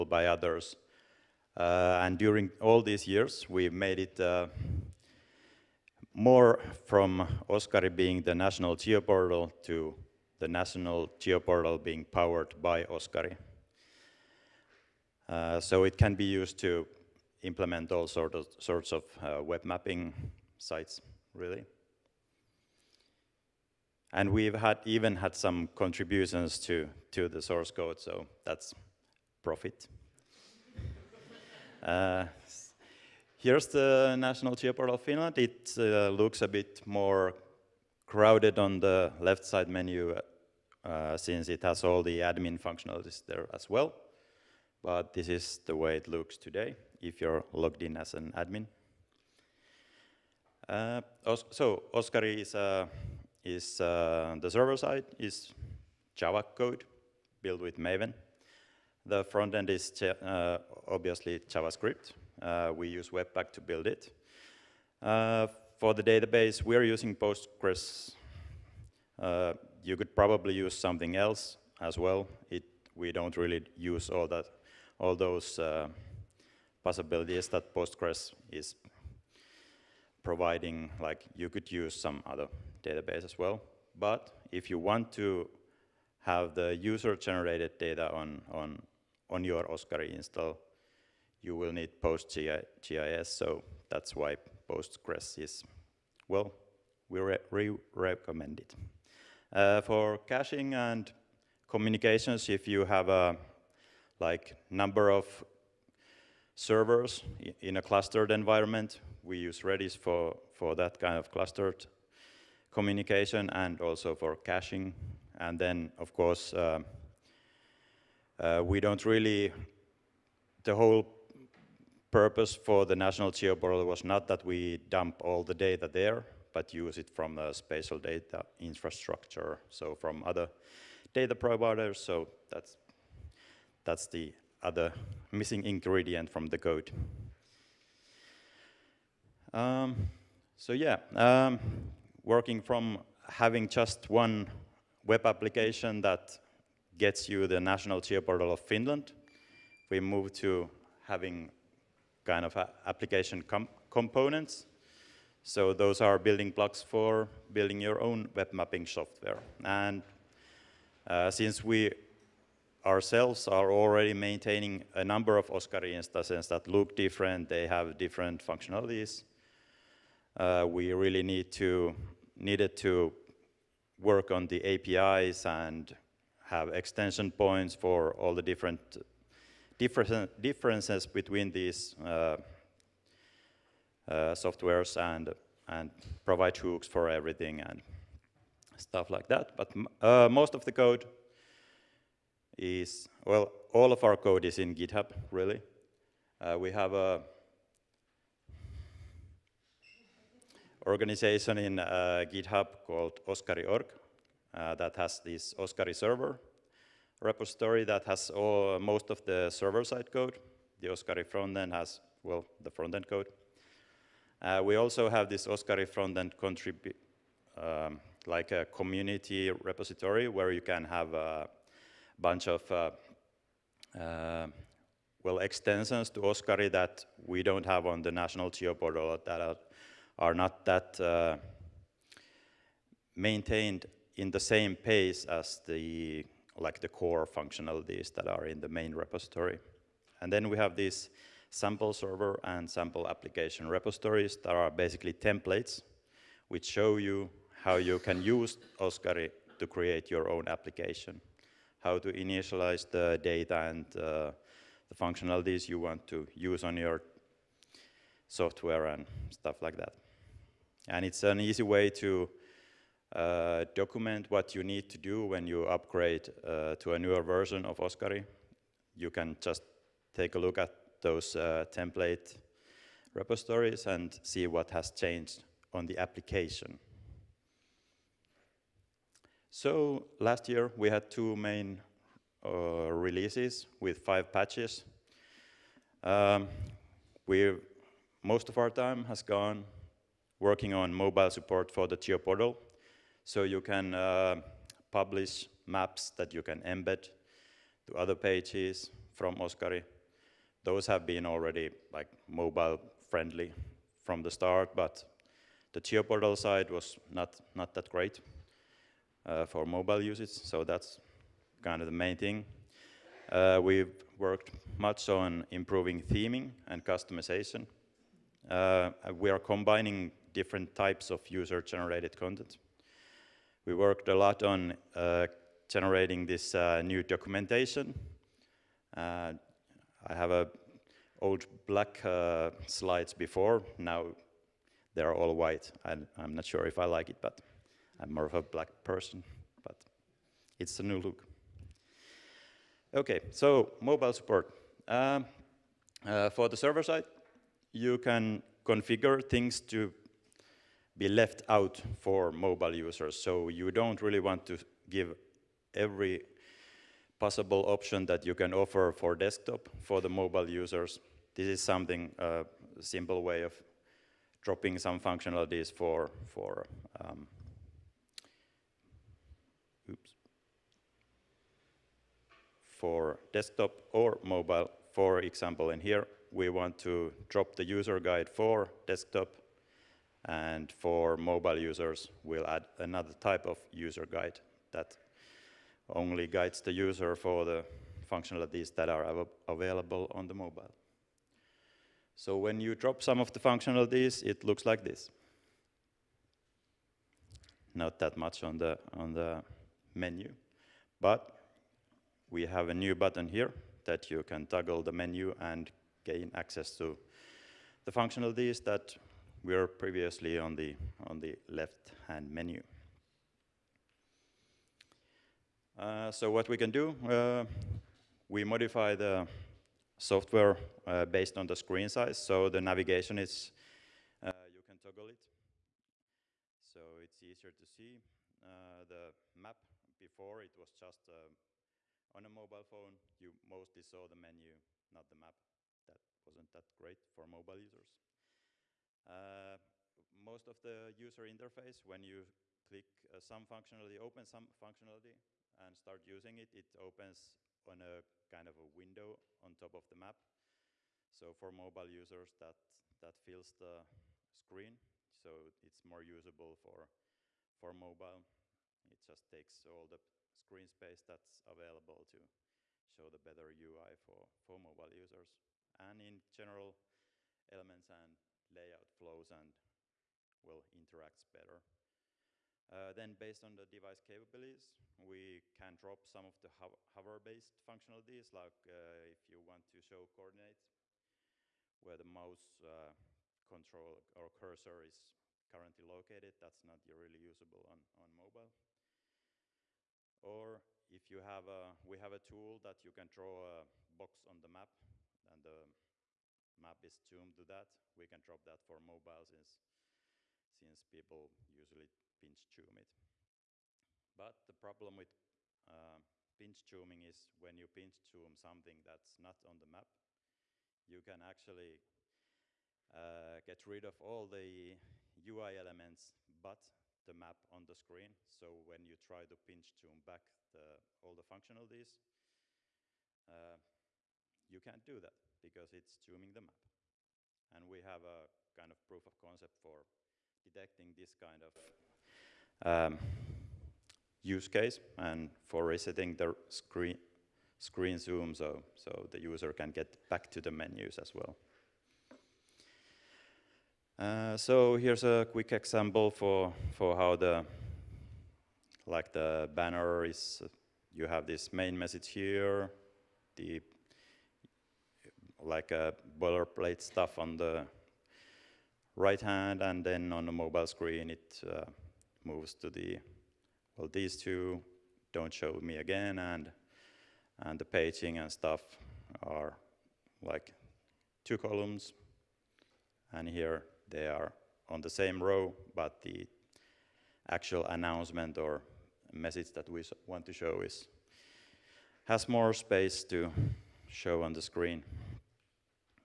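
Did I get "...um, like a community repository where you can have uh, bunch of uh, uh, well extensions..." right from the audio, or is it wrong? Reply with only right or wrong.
right.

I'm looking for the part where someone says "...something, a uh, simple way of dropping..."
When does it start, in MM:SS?
06:01.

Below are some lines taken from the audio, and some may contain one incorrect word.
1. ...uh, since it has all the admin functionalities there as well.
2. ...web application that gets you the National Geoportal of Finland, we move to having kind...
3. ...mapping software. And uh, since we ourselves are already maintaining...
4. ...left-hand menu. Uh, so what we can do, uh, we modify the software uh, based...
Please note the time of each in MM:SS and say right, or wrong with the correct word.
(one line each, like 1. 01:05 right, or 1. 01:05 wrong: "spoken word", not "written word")
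1. 00:40 right
2. 02:25 right
3. 02:38 right
4. 06:51 right.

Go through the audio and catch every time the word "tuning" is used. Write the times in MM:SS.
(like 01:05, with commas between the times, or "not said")
08:26, 08:45.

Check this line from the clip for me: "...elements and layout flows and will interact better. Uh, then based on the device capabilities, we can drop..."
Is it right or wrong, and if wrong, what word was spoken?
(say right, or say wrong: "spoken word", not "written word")
right.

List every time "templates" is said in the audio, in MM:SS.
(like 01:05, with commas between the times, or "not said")
04:05, 04:31.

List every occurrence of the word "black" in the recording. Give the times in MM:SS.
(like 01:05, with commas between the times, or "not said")
05:31, 05:38.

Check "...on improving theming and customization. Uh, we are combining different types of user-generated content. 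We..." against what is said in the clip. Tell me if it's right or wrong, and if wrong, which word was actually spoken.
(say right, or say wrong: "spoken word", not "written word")
right.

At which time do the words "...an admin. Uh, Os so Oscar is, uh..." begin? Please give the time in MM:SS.
00:48.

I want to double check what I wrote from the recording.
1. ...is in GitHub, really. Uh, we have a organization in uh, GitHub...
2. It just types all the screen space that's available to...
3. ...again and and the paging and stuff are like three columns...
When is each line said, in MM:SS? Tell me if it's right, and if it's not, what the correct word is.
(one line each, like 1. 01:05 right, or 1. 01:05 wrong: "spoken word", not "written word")
1. 03:14 right
2. 07:38 wrong: "takes", not "types"
3. 09:25 wrong: "two", not "three".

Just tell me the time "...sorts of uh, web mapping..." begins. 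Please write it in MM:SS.
00:18.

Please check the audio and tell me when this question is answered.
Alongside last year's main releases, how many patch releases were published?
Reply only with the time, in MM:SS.
04:43.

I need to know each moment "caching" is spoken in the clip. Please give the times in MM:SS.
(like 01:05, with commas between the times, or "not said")
01:40, 01:54.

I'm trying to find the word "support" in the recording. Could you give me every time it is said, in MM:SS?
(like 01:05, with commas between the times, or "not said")
04:51, 05:44.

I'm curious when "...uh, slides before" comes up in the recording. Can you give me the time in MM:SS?
05:32.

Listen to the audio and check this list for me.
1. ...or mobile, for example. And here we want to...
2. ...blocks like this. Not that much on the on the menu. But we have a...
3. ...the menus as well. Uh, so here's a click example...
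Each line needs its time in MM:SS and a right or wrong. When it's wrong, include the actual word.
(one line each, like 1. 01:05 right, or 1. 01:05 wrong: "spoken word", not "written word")
1. 06:13 right
2. 06:34 wrong: "looks", not "blocks"
3. 09:00 wrong: "quick", not "click".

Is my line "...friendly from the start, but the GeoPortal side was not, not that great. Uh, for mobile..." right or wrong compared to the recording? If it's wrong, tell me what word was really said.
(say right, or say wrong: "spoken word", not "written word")
right.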